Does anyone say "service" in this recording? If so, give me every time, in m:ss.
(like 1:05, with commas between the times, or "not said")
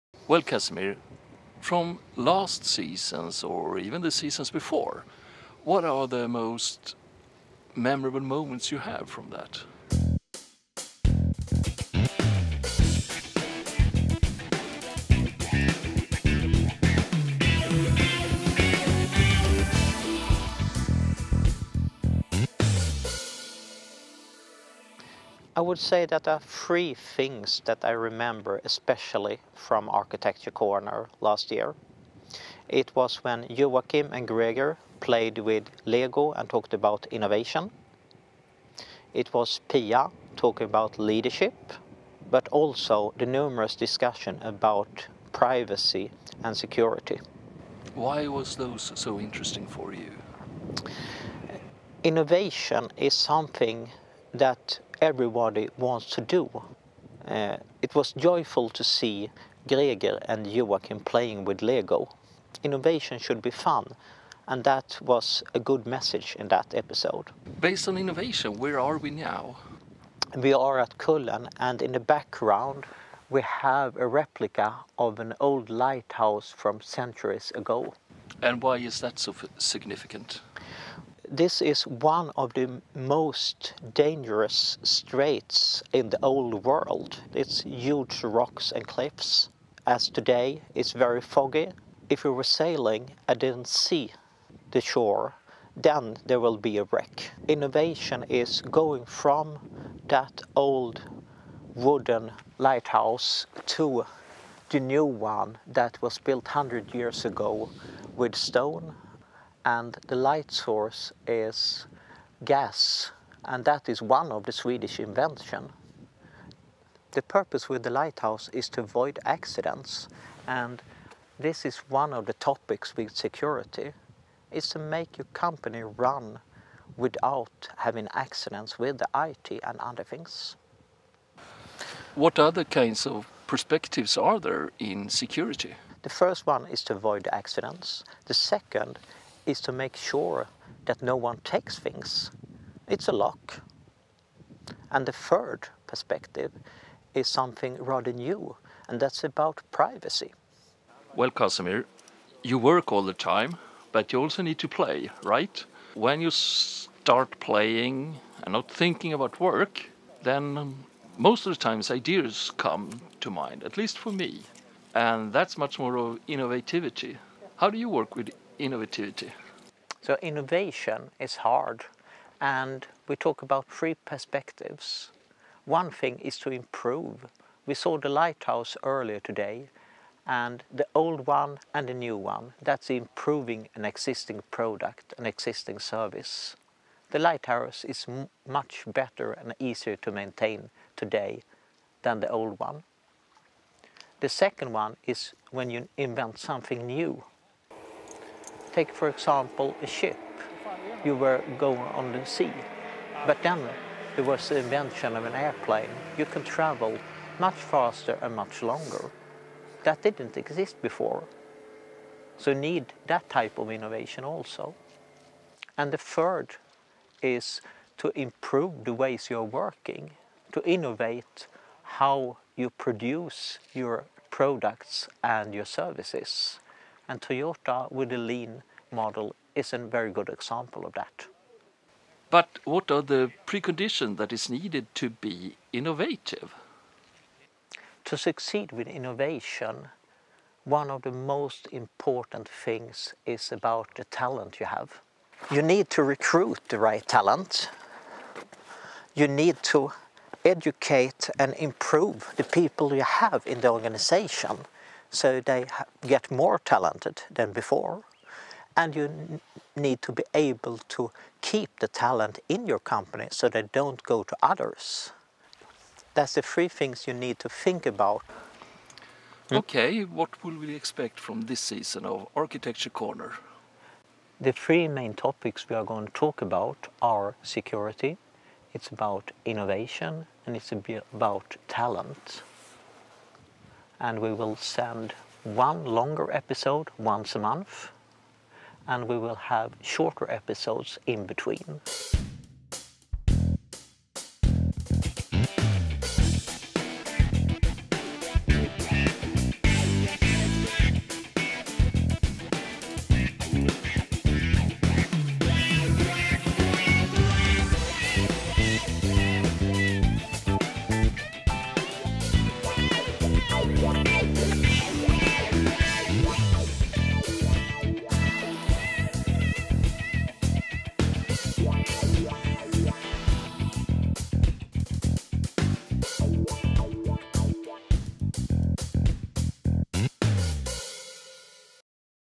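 3:05, 3:45.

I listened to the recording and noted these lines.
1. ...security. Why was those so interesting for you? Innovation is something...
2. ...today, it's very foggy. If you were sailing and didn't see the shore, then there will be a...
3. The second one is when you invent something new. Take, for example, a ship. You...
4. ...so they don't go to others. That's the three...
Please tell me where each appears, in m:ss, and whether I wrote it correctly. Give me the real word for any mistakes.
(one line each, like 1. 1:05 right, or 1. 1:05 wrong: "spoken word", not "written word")
1. 0:46 right
2. 1:30 right
3. 3:14 right
4. 4:23 right.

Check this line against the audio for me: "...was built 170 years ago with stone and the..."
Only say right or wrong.
wrong.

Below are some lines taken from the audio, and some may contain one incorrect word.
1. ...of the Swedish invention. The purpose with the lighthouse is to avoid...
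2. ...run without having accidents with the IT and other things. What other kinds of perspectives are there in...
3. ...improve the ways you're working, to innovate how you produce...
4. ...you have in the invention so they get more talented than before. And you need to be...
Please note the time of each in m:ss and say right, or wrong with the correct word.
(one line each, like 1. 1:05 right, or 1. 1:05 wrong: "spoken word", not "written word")
1. 1:54 right
2. 2:05 right
3. 3:38 right
4. 4:12 wrong: "organization", not "invention".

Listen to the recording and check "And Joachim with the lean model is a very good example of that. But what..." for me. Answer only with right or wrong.
wrong.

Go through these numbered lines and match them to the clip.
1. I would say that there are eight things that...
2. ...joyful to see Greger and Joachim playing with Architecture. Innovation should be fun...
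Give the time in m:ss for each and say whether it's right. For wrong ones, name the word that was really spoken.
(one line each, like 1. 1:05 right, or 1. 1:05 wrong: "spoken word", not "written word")
1. 0:25 wrong: "three", not "eight"
2. 0:58 wrong: "Lego", not "Architecture".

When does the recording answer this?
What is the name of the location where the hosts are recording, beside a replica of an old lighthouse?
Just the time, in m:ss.
1:10.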